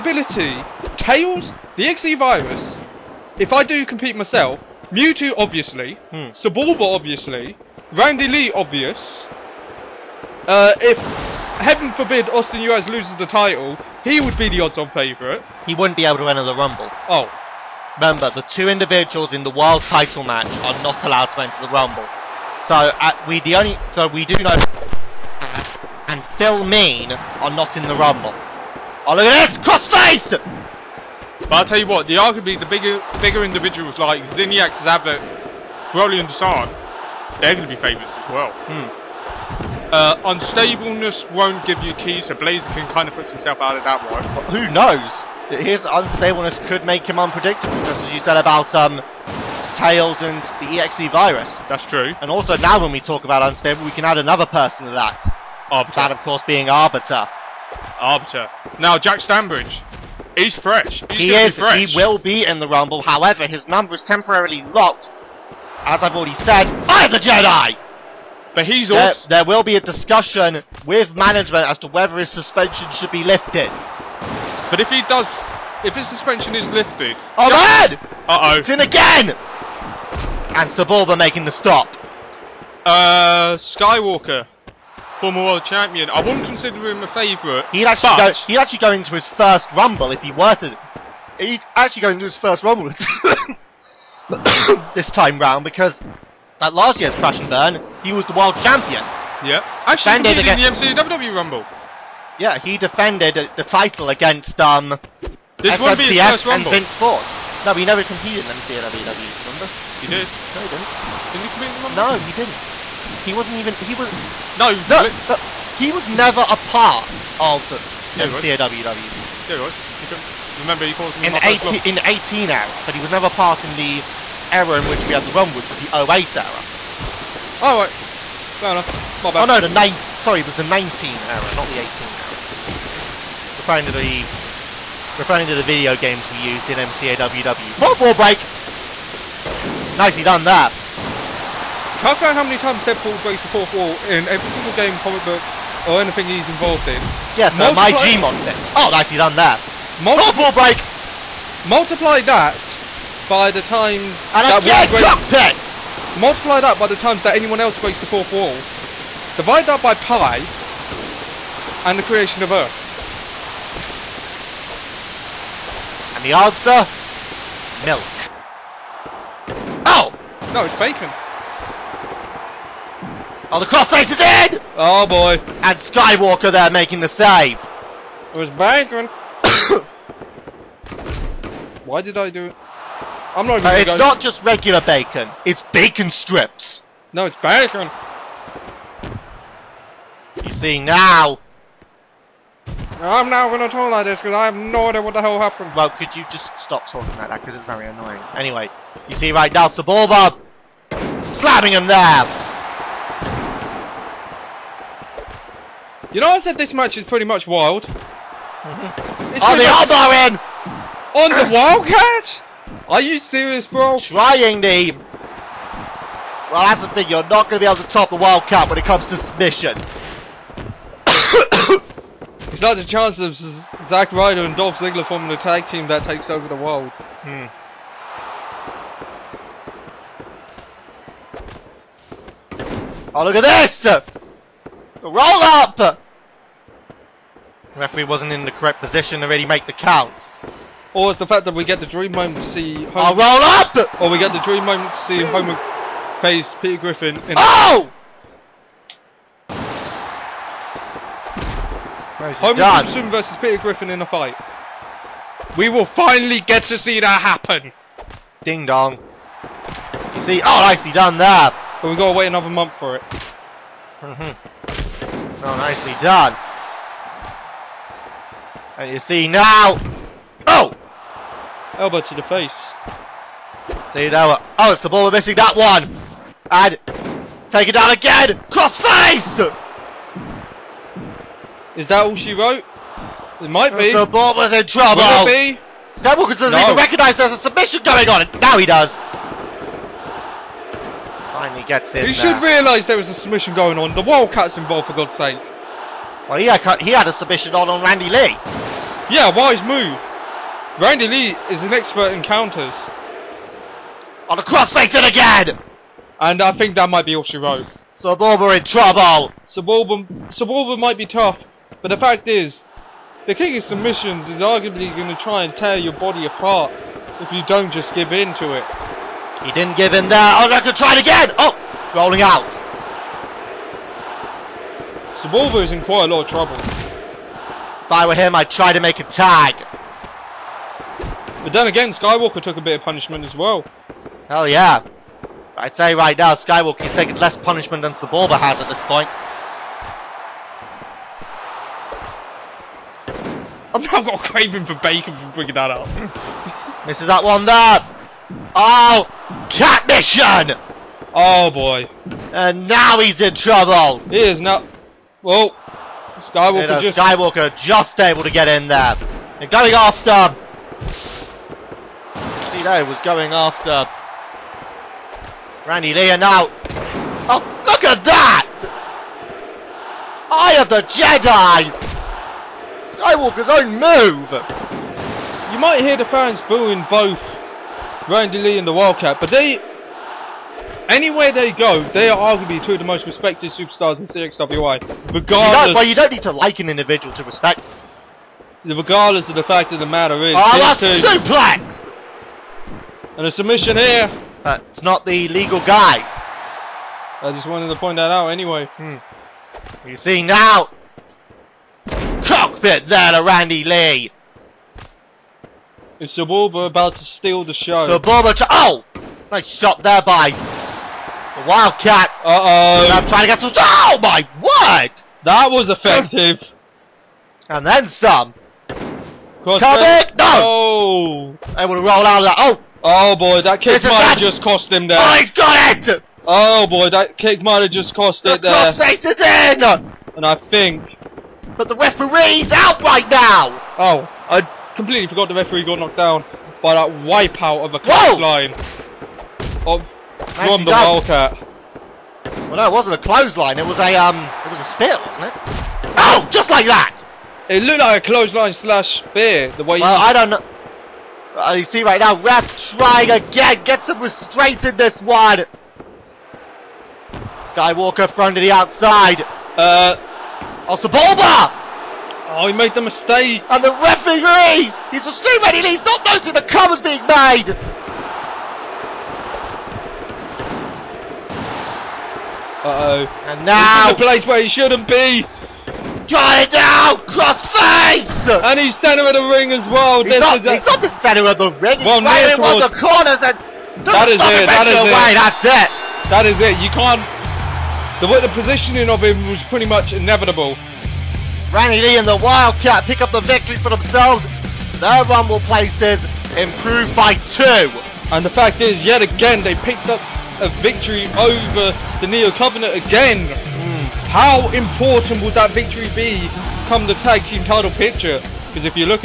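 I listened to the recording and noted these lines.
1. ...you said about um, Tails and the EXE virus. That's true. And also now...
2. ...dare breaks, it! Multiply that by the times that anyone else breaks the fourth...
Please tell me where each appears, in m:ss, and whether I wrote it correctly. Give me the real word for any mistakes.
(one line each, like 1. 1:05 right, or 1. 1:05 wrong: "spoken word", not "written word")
1. 0:48 right
2. 2:34 right.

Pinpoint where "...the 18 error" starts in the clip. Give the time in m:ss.
2:11.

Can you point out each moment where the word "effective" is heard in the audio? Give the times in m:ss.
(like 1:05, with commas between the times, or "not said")
6:55.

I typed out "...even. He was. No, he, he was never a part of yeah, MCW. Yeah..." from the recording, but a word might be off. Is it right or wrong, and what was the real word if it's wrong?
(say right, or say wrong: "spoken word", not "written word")
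right.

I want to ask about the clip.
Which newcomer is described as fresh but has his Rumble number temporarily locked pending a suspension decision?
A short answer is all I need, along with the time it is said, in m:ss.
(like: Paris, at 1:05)
Jack Stanbridge, at 0:58.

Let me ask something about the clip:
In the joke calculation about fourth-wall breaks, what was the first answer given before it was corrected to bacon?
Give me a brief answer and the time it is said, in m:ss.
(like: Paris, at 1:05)
Milk, at 2:47.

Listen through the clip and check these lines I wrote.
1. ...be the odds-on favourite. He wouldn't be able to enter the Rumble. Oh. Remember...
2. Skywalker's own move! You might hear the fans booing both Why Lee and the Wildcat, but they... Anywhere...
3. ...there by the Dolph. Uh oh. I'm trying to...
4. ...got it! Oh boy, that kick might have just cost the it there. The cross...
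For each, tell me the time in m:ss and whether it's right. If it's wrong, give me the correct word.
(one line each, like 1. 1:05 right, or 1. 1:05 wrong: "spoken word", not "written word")
1. 0:14 right
2. 6:12 wrong: "Randy", not "Why"
3. 6:49 wrong: "Wildcat", not "Dolph"
4. 7:05 right.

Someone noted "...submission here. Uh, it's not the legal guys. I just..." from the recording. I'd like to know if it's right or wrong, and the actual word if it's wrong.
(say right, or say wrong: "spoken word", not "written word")
right.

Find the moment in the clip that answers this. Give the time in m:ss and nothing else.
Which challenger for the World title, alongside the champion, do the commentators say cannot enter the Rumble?
0:26.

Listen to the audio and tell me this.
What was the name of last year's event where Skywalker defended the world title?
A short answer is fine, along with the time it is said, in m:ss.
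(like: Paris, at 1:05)
Crash and Burn, at 1:37.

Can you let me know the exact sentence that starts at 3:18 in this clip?
Anyway, you see right now, Saboba slamming him there.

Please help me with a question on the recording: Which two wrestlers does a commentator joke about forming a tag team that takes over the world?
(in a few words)
Zack Ryder and Dolph Ziggler.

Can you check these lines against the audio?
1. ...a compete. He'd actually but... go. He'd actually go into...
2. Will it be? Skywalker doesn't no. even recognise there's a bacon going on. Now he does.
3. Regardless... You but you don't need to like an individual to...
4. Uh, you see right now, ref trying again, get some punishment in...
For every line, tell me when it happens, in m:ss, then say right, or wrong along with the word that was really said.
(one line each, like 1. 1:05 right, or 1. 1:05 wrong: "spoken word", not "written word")
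1. 1:27 wrong: "favourite", not "compete"
2. 4:45 wrong: "submission", not "bacon"
3. 6:25 right
4. 7:31 wrong: "restraint", not "punishment".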